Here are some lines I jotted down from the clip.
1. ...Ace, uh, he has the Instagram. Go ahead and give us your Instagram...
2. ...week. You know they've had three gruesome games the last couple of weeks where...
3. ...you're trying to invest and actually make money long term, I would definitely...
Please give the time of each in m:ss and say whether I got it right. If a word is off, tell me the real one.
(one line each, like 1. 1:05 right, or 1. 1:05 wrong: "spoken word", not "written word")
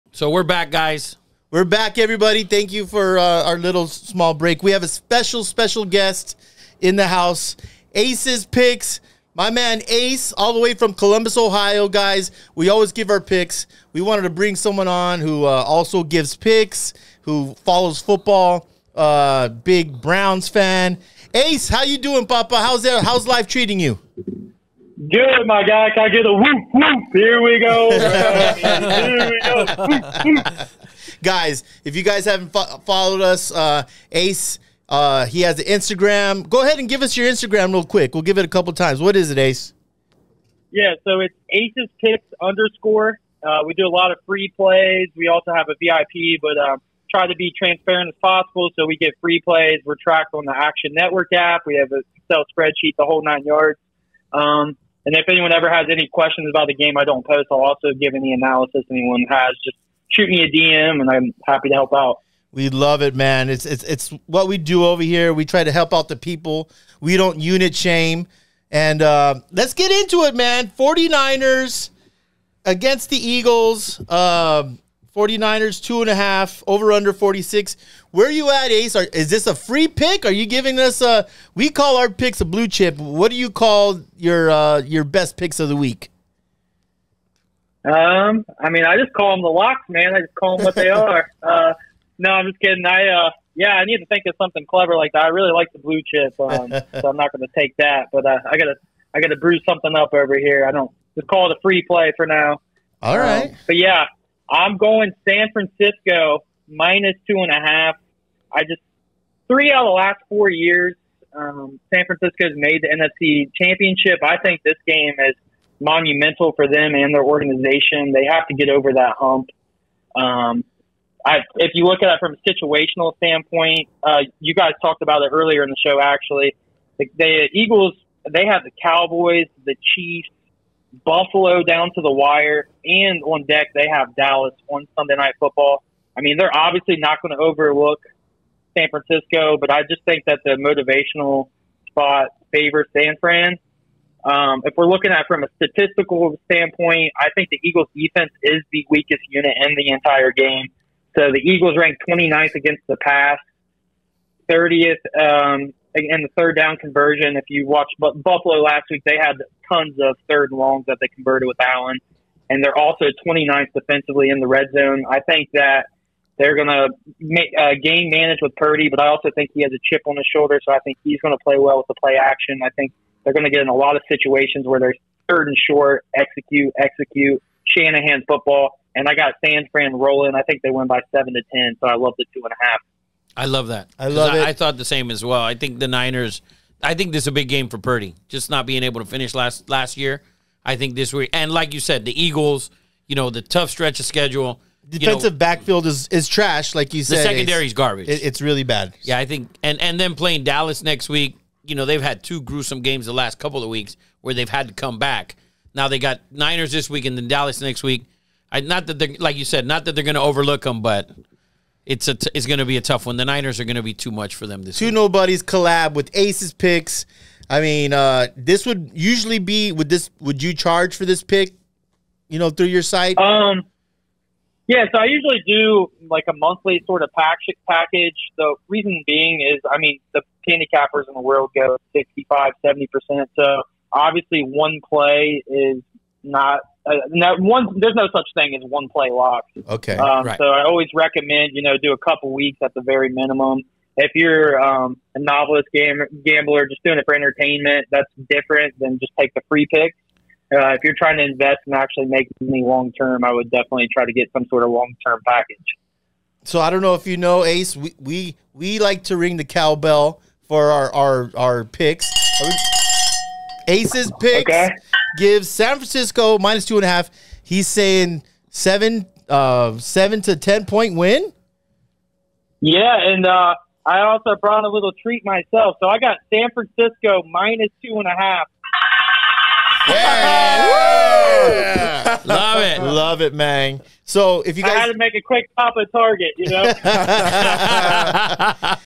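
1. 0:34 right
2. 3:21 wrong: "two", not "three"
3. 4:10 right.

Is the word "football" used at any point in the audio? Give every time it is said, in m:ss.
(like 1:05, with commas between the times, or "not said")
0:17, 2:15, 2:58.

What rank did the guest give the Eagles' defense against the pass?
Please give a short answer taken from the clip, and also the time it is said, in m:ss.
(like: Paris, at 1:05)
29th, at 2:32.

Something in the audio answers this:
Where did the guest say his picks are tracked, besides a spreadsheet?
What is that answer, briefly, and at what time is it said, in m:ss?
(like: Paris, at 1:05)
Action Network app, at 0:50.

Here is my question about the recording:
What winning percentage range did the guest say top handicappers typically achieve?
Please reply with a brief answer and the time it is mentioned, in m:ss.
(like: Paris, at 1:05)
65 to 70 percent, at 3:51.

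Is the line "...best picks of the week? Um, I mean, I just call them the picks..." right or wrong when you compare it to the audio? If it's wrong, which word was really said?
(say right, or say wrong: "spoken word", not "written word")
wrong: "locks", not "picks".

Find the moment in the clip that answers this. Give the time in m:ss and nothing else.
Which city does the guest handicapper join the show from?
0:10.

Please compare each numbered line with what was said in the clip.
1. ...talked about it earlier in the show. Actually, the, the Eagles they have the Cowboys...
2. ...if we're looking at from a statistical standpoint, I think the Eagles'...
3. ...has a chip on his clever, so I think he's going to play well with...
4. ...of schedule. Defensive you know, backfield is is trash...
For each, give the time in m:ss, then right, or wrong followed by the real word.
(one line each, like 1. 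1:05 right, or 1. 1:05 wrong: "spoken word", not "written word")
1. 2:04 right
2. 2:24 right
3. 2:49 wrong: "shoulder", not "clever"
4. 3:13 right.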